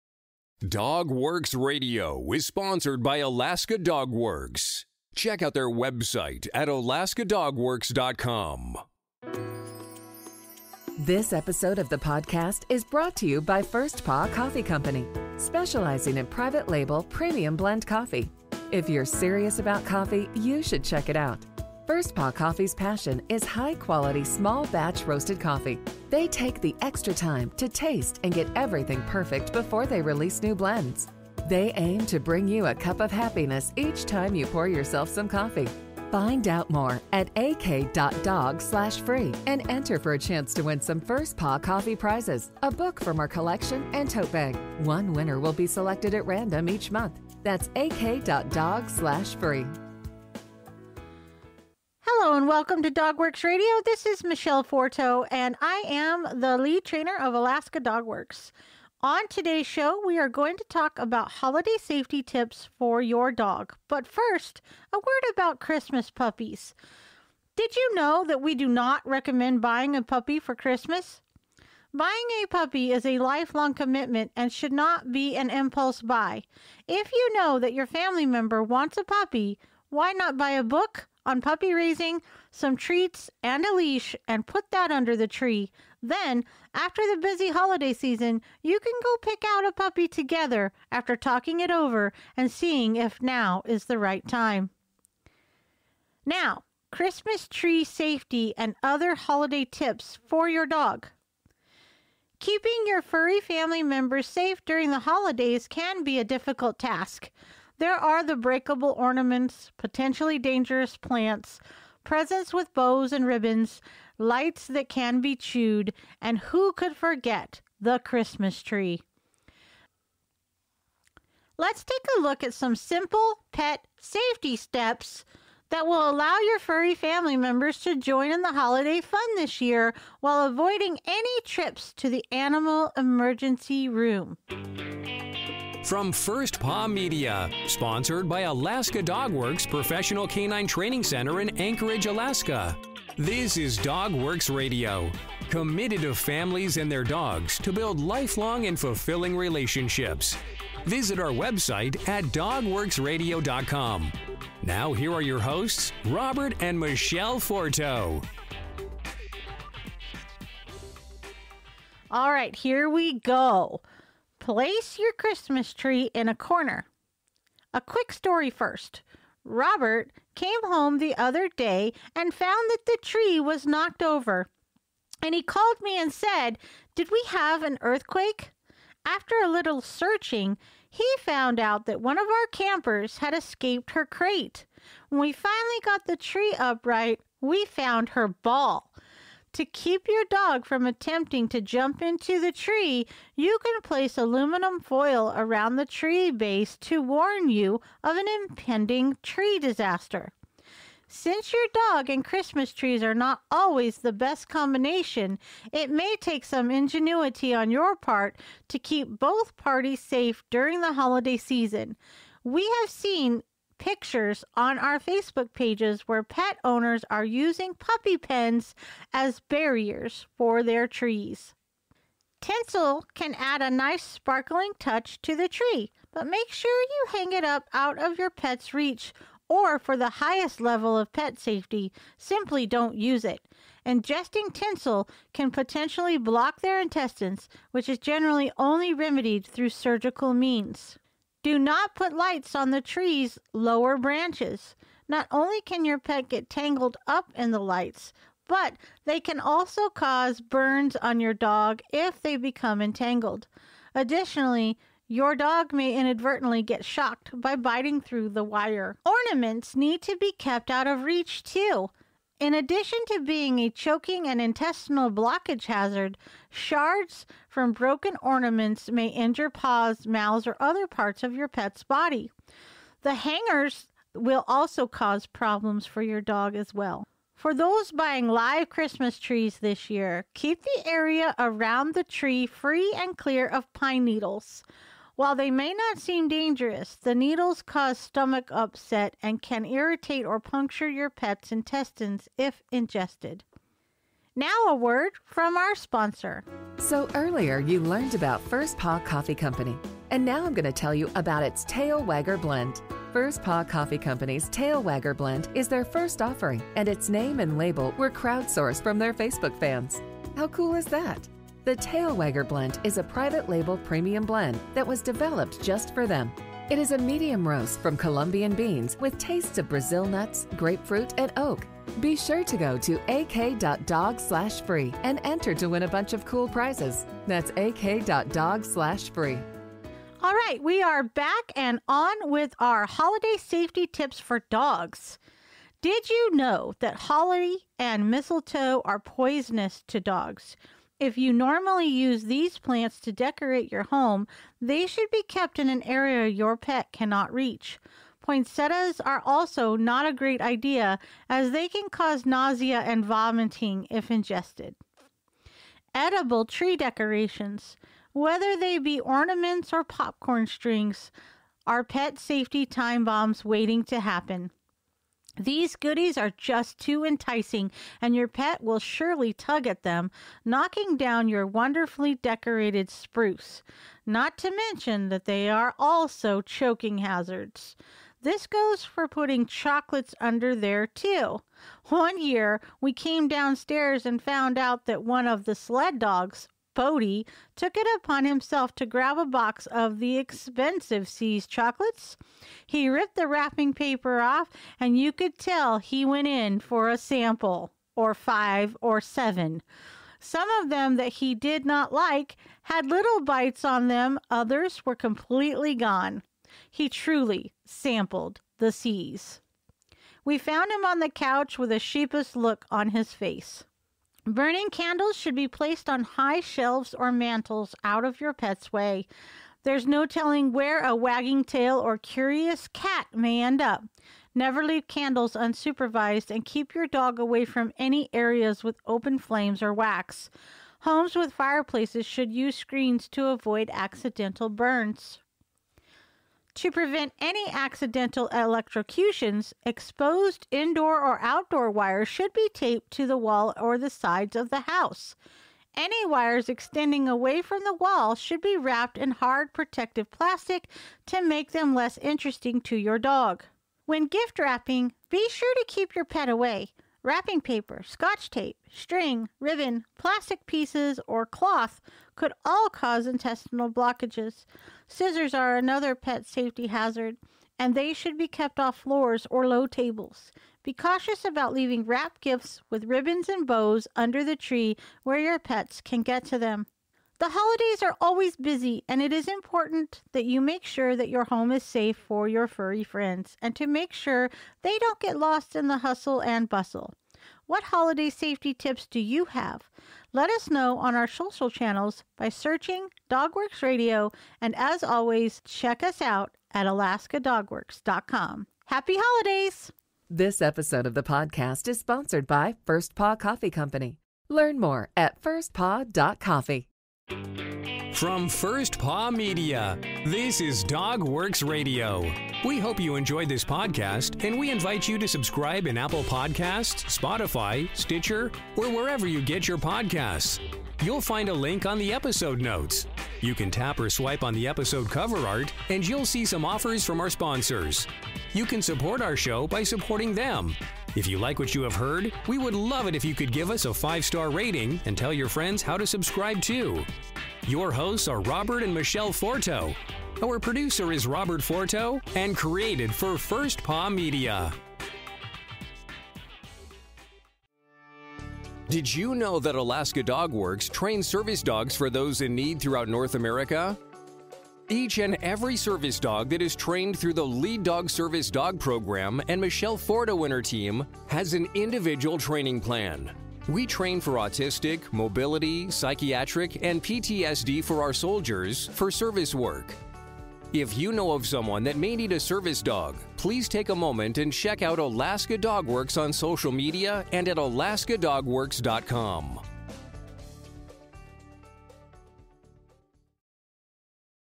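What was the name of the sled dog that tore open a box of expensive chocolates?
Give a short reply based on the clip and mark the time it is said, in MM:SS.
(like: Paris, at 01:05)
Bodie, at 06:26.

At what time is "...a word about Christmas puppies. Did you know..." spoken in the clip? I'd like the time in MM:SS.
01:04.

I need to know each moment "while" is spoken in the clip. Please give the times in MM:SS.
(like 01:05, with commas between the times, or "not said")
02:10, 04:45.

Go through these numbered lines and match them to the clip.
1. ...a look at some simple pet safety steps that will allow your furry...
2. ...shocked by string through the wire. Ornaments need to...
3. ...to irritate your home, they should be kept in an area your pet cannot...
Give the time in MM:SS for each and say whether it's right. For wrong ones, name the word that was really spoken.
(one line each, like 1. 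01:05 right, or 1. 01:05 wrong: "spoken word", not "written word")
1. 02:02 right
2. 04:16 wrong: "biting", not "string"
3. 05:42 wrong: "decorate", not "irritate".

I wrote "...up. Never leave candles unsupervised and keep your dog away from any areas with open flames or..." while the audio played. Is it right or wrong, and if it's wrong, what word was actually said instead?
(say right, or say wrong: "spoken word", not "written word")
right.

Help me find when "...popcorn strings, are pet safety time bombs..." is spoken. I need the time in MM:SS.
05:59.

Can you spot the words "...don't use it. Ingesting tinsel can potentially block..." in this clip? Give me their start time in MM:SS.
03:52.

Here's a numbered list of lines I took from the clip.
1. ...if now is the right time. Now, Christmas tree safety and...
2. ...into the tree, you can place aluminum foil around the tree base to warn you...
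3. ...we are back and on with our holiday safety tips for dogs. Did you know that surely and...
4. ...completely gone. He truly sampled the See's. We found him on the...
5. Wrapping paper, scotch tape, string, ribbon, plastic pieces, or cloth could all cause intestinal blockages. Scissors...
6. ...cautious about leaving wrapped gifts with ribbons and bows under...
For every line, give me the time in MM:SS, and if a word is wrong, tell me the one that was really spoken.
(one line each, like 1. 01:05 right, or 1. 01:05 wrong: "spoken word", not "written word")
1. 01:32 right
2. 03:12 right
3. 05:30 wrong: "holly", not "surely"
4. 06:44 right
5. 07:37 right
6. 07:50 right.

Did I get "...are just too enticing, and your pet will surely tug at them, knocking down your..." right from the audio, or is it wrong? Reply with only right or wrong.
right.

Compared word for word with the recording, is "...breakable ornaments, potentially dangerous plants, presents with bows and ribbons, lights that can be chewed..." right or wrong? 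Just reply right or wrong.
right.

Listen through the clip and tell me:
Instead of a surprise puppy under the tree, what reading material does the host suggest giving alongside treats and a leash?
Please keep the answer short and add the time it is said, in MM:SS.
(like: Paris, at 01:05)
A book on puppy raising, at 01:20.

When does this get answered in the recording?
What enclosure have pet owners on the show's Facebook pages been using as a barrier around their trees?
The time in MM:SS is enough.
03:37.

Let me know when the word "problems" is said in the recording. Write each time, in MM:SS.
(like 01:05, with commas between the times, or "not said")
04:35.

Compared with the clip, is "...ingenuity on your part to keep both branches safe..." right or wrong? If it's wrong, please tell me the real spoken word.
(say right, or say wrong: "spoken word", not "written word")
wrong: "parties", not "branches".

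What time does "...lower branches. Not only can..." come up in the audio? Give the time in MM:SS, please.
04:03.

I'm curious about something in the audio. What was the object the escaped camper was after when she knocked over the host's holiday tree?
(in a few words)
Her ball.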